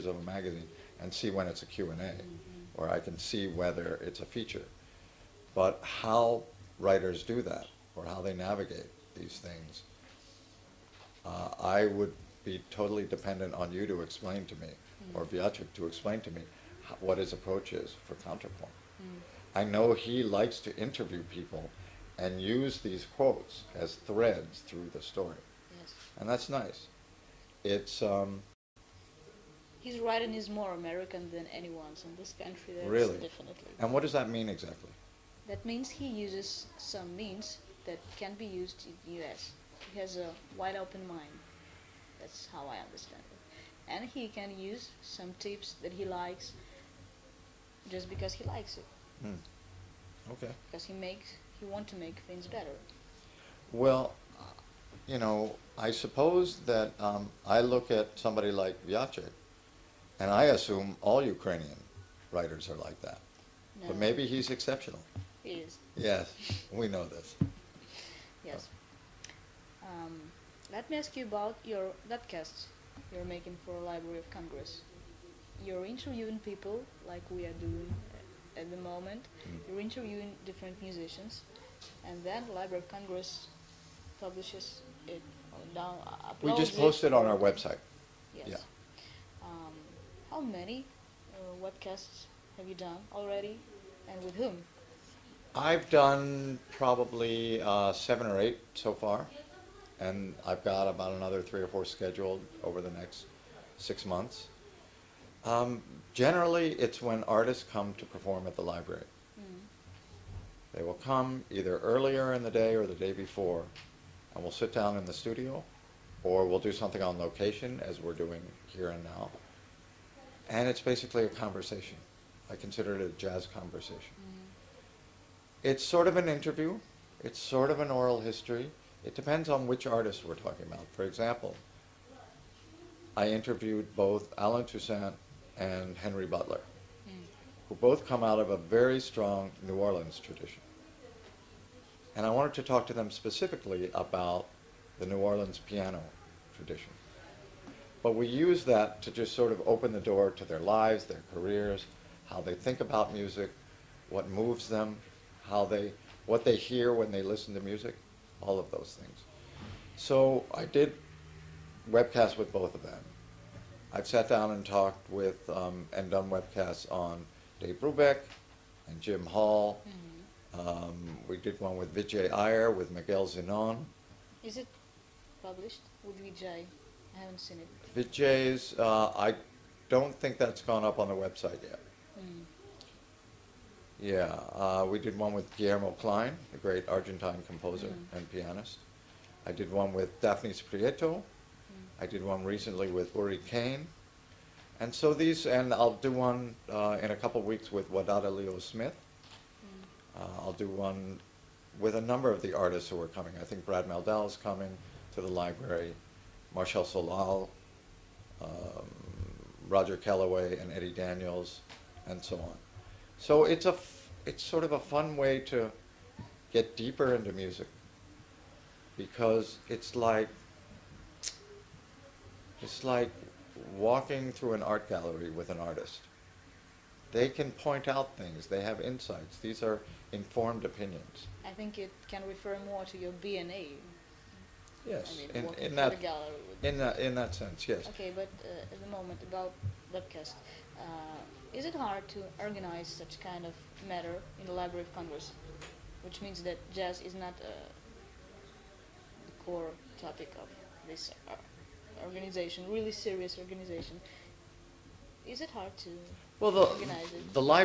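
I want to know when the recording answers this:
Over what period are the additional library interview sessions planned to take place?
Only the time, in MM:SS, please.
01:43.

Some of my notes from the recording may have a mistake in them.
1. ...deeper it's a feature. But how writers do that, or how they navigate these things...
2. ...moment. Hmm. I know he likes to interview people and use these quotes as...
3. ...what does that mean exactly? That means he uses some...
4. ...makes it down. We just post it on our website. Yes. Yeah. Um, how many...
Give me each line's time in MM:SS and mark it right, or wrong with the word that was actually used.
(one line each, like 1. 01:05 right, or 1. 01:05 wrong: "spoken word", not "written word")
1. 00:03 wrong: "whether", not "deeper"
2. 00:18 wrong: "counterpoint", not "moment"
3. 00:33 right
4. 01:24 wrong: "publishes", not "makes".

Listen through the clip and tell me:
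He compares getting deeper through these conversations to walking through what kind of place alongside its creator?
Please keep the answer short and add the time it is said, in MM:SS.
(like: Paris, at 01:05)
An art gallery, at 03:44.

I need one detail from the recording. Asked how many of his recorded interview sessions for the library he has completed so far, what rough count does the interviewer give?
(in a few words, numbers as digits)
7 or 8.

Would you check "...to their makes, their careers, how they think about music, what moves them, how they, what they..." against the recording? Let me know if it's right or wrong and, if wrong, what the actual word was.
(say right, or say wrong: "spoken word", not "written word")
wrong: "lives", not "makes".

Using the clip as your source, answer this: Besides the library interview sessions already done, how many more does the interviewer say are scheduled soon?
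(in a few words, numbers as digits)
3 or 4.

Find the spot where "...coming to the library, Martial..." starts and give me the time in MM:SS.
03:24.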